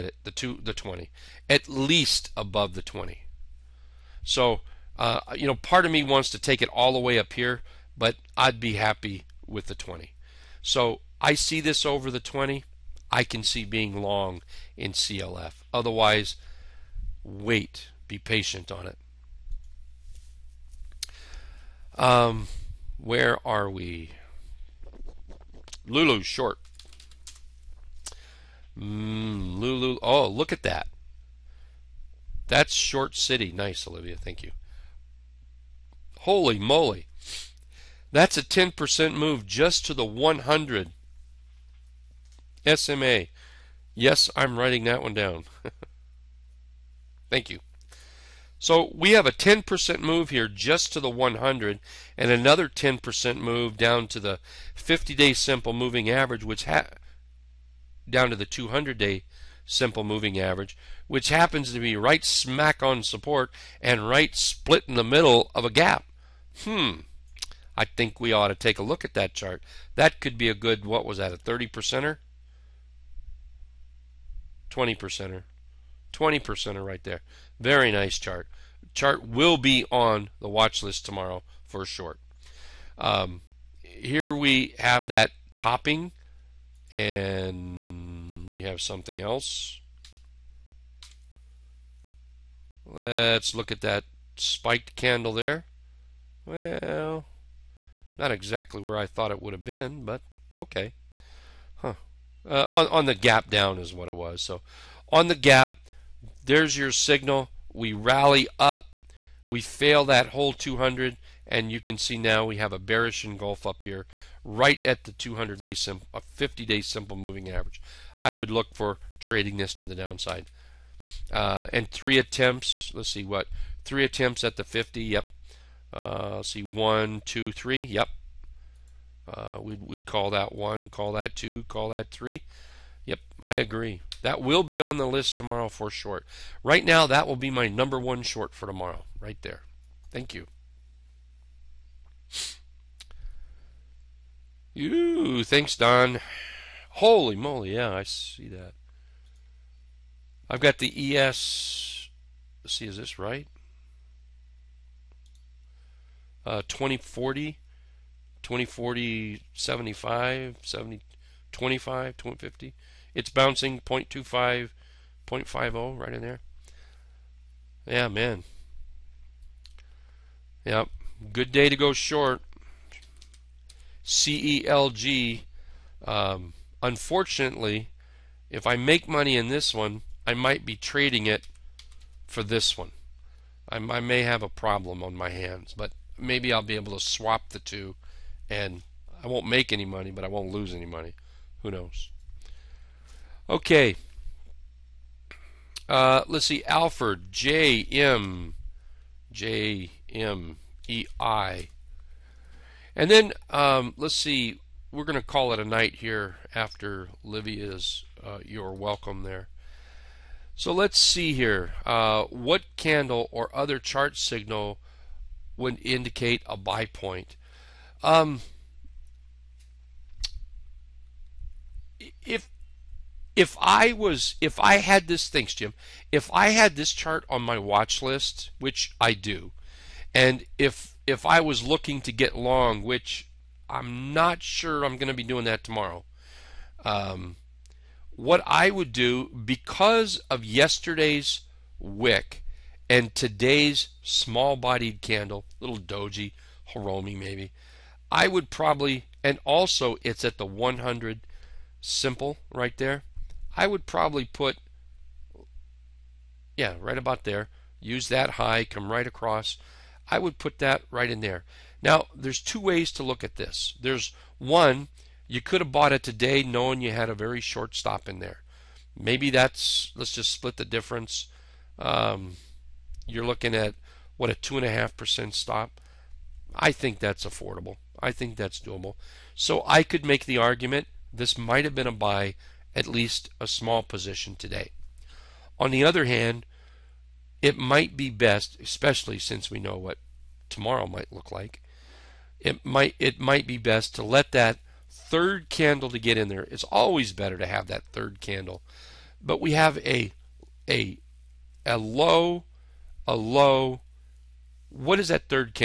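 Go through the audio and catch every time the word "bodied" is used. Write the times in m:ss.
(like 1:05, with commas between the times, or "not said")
4:04.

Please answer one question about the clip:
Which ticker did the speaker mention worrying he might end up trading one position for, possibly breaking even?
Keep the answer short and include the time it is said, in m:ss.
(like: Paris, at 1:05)
CELG, at 2:54.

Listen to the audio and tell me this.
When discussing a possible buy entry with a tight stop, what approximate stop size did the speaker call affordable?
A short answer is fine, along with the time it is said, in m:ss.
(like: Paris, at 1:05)
2.5%, at 4:34.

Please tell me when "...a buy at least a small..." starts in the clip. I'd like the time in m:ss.
4:41.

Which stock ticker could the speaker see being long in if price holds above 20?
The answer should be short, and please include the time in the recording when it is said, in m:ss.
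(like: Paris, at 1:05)
CLF, at 0:14.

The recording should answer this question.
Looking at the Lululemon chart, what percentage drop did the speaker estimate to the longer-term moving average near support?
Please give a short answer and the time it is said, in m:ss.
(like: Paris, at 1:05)
20%, at 1:14.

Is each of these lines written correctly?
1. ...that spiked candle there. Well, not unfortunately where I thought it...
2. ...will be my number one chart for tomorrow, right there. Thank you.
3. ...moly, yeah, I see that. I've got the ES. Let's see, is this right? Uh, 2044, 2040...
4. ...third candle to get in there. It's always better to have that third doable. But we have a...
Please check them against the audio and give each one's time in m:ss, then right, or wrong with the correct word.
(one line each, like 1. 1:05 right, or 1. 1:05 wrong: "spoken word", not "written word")
1. 1:33 wrong: "exactly", not "unfortunately"
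2. 2:17 wrong: "short", not "chart"
3. 2:27 wrong: "2040", not "2044"
4. 4:54 wrong: "candle", not "doable".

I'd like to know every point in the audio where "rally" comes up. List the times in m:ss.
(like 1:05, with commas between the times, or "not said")
1:47.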